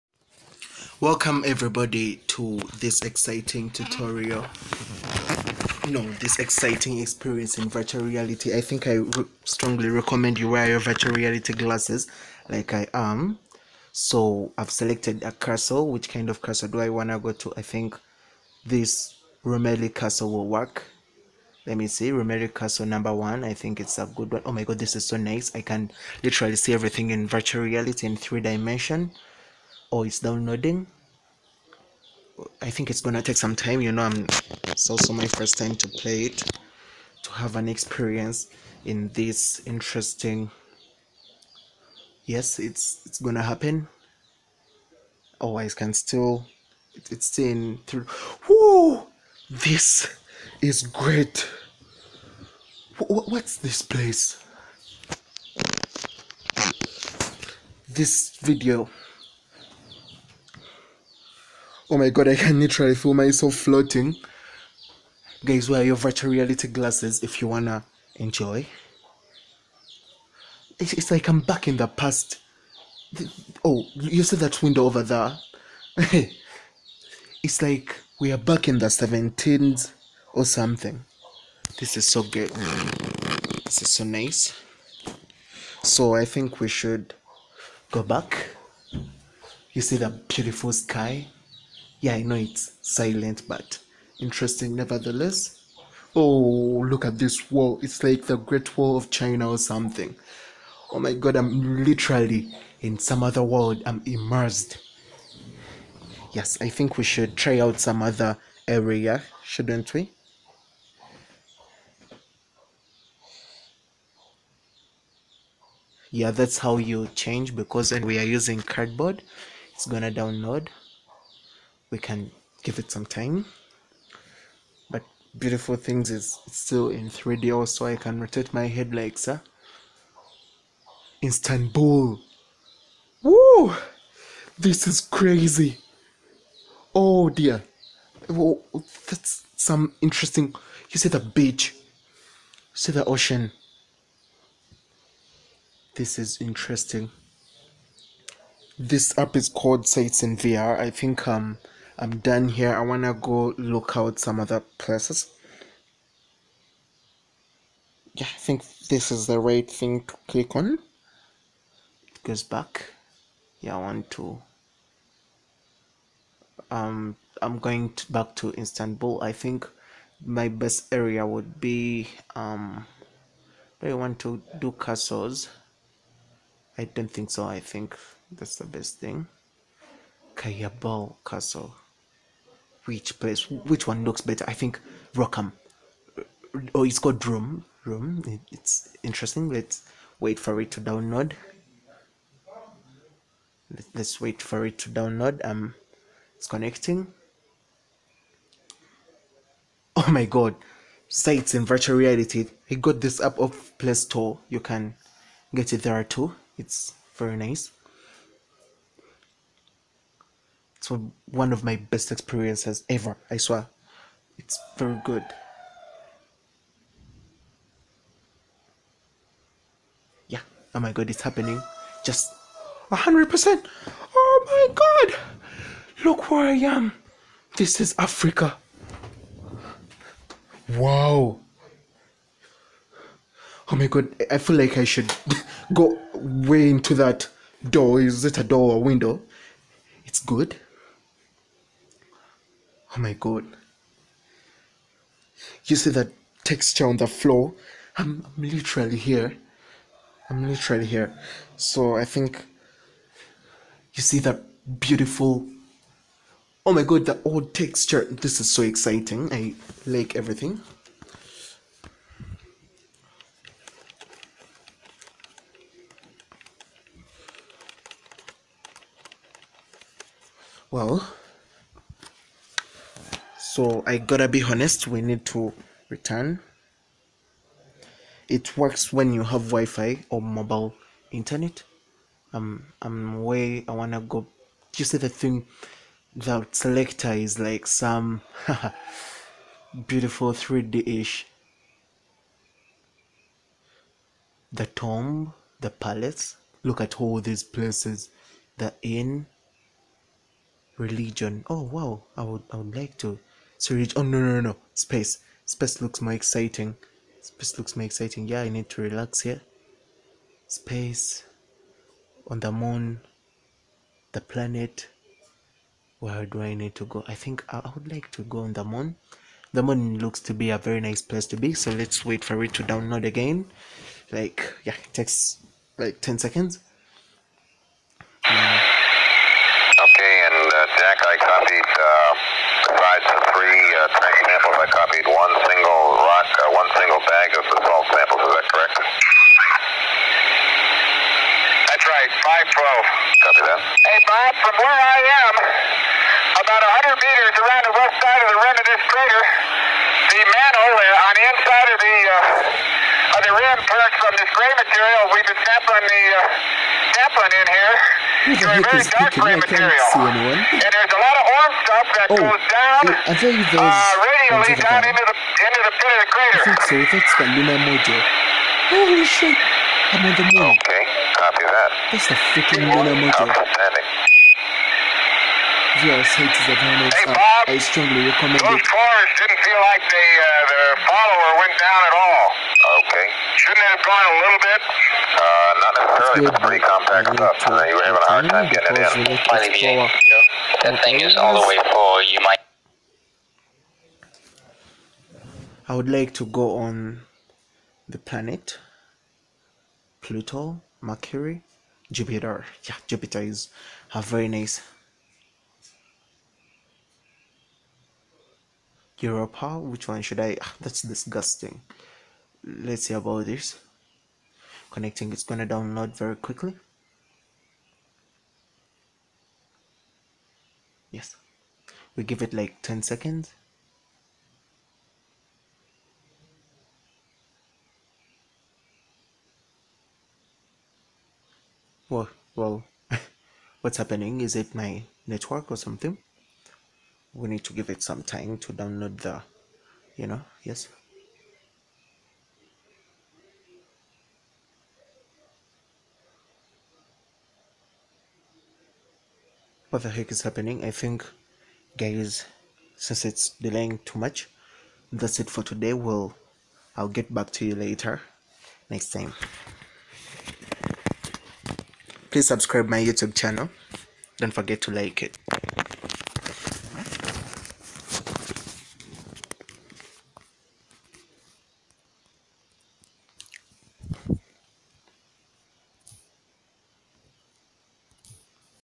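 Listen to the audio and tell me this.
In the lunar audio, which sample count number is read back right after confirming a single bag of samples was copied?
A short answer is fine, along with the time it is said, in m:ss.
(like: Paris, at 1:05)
512, at 5:42.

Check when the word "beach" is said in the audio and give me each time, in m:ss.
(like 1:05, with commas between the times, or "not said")
2:21.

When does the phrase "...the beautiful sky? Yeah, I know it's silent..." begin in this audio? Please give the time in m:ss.
1:29.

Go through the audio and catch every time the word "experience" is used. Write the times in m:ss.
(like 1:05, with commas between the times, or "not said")
0:06, 0:37, 3:32.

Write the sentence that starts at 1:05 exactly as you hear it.
Guys, wear your virtual reality glasses if you wanna enjoy.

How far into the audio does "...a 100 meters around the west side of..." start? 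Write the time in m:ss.
5:46.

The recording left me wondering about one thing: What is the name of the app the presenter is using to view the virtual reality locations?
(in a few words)
Sites in VR.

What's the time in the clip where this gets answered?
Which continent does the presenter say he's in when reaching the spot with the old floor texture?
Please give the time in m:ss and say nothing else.
3:47.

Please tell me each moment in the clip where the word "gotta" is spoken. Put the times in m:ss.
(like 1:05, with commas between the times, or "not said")
4:33.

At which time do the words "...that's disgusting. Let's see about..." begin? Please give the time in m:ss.
6:50.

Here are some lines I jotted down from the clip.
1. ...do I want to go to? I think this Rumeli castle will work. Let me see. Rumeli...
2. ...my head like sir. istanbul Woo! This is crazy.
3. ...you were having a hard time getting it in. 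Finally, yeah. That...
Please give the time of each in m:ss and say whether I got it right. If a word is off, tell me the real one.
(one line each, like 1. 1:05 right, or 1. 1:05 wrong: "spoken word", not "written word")
1. 0:16 right
2. 2:08 right
3. 6:27 right.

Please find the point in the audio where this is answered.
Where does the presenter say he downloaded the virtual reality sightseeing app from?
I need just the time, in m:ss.
3:23.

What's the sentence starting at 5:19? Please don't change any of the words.
The moon looks to be a very nice place to be, so let's wait for it to download again.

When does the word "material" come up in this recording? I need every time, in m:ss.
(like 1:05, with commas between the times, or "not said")
5:54, 5:59.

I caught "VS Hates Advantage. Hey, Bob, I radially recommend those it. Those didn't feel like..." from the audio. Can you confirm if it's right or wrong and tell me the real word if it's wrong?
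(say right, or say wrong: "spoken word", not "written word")
wrong: "strongly", not "radially".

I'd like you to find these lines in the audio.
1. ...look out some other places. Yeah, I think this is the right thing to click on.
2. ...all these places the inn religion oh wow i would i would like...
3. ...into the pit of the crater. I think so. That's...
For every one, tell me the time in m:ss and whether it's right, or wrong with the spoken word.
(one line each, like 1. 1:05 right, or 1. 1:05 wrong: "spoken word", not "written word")
1. 2:33 right
2. 4:57 right
3. 6:05 right.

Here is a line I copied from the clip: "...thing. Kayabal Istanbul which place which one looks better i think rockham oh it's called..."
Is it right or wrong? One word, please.
wrong.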